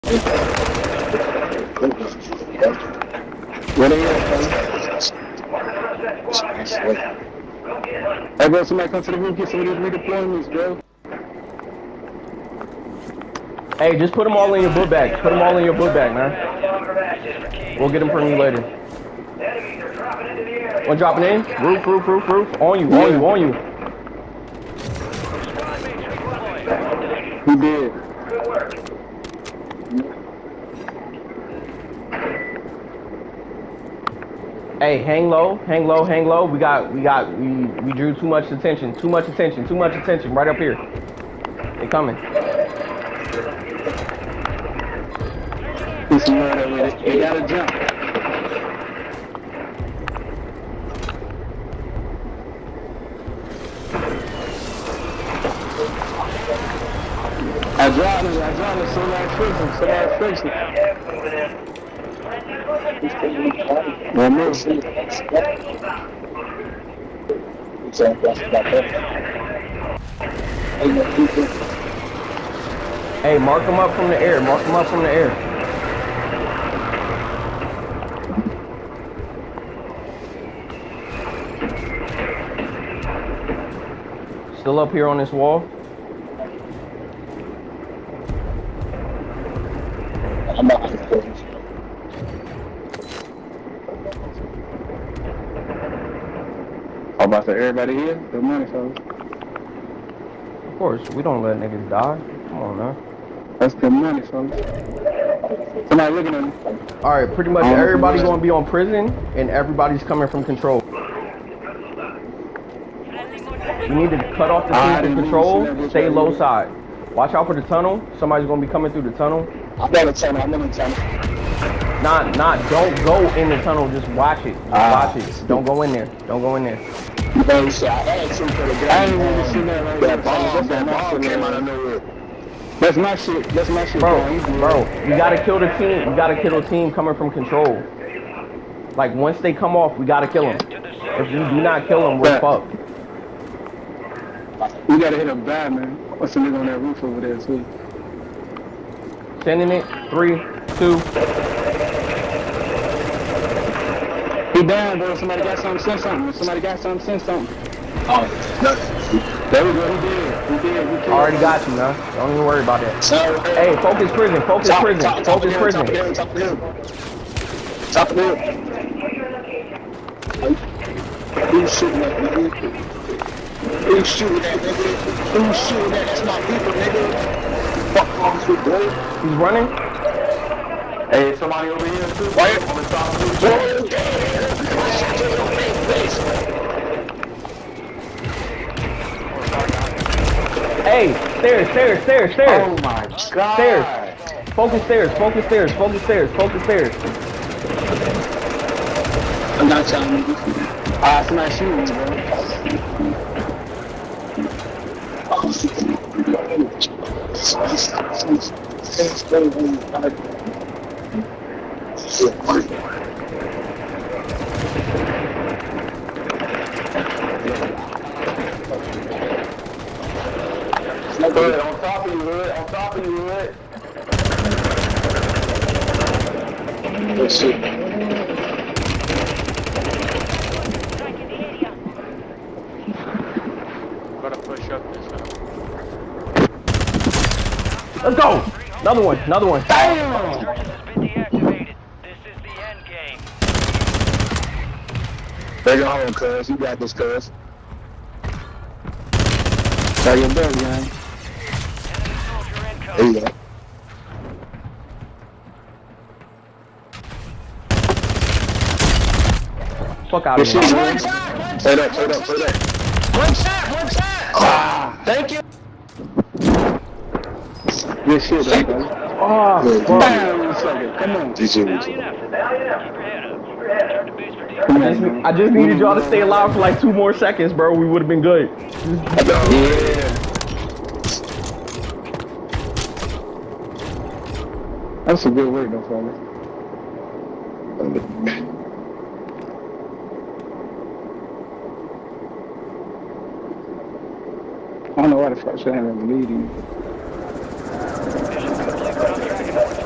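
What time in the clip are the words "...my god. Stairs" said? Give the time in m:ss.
3:12.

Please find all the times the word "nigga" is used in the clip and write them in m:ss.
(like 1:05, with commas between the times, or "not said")
1:41, 2:26, 2:56.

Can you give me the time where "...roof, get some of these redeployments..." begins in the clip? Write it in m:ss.
0:09.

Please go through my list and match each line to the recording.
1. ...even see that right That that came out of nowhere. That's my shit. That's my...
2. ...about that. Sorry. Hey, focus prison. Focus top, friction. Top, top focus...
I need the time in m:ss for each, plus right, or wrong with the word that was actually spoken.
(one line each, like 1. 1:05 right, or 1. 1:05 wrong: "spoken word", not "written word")
1. 2:07 right
2. 2:42 wrong: "prison", not "friction".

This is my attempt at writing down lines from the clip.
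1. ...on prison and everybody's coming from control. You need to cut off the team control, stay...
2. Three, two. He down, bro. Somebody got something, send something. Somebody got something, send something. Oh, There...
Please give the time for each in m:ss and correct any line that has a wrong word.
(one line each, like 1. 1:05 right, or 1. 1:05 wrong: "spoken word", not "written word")
1. 1:48 right
2. 2:30 right.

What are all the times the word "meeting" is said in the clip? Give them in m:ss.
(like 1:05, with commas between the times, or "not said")
4:55.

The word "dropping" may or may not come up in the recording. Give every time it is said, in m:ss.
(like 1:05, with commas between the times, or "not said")
0:20.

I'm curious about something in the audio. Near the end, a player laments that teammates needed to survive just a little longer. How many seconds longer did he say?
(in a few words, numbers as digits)
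2.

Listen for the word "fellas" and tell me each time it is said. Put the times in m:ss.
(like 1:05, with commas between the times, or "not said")
1:38, 1:44.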